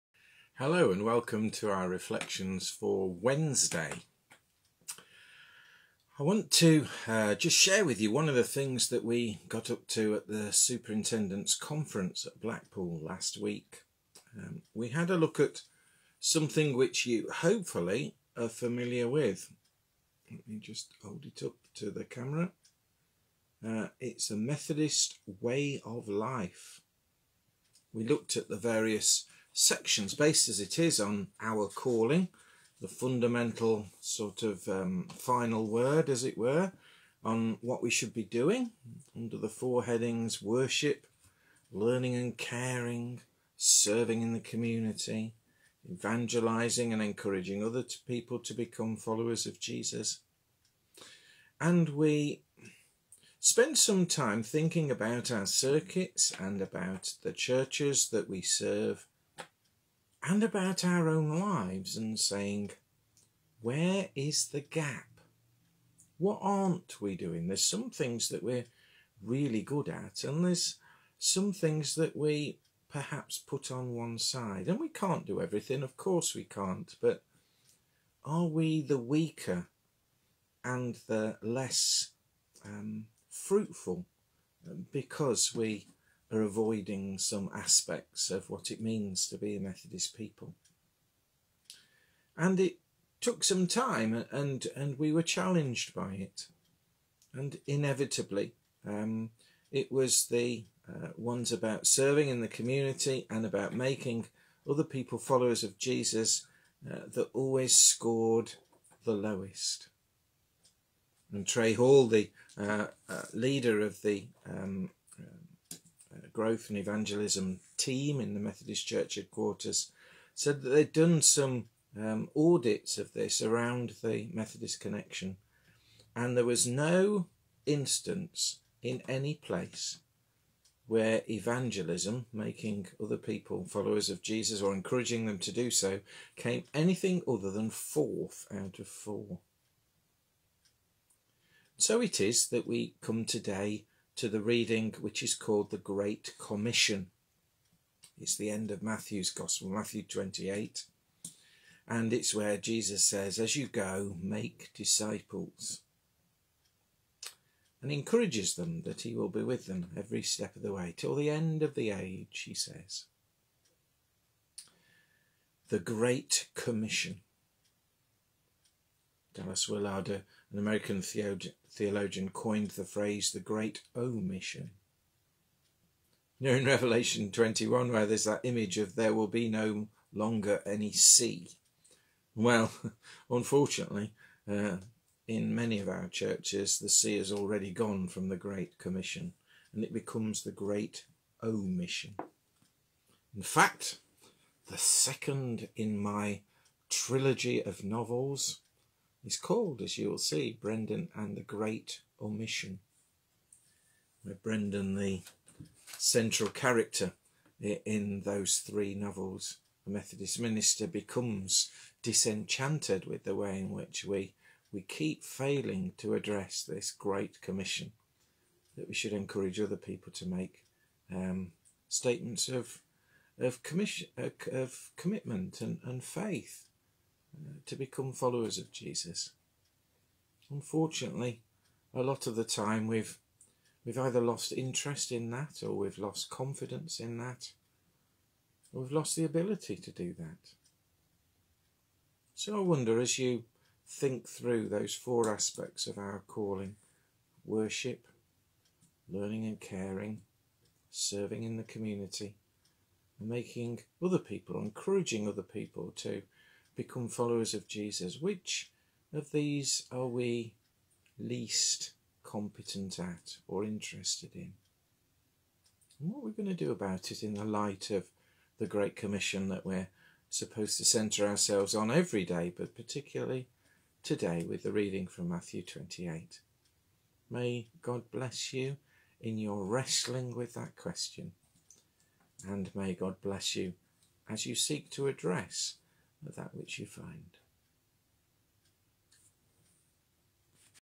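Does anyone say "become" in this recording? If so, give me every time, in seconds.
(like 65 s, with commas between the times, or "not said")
48 s, 189 s, 210 s, 227 s, 256 s.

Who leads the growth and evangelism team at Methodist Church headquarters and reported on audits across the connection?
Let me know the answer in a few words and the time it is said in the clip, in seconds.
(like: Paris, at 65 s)
Trey Hall, at 111 s.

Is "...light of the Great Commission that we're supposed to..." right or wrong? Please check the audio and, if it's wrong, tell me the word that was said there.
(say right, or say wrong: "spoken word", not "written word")
right.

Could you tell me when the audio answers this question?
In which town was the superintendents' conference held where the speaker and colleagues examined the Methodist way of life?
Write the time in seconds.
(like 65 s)
12 s.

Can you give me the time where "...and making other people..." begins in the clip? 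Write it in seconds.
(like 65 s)
253 s.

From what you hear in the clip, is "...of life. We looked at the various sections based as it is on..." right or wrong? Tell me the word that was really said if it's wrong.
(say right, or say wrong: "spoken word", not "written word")
right.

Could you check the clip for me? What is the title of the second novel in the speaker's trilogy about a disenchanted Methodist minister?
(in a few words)
Brendan and the Great Omission.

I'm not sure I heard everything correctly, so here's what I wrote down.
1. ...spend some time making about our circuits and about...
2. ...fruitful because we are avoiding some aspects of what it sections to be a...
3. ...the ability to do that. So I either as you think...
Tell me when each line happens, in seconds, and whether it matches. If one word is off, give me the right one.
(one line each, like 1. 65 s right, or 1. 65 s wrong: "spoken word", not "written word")
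1. 53 s wrong: "thinking", not "making"
2. 83 s wrong: "means", not "sections"
3. 239 s wrong: "wonder", not "either".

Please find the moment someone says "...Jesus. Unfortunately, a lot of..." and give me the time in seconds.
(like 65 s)
228 s.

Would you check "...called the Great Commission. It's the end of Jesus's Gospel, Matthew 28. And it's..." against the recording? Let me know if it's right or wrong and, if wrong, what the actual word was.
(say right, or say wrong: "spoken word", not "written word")
wrong: "Matthew", not "Jesus".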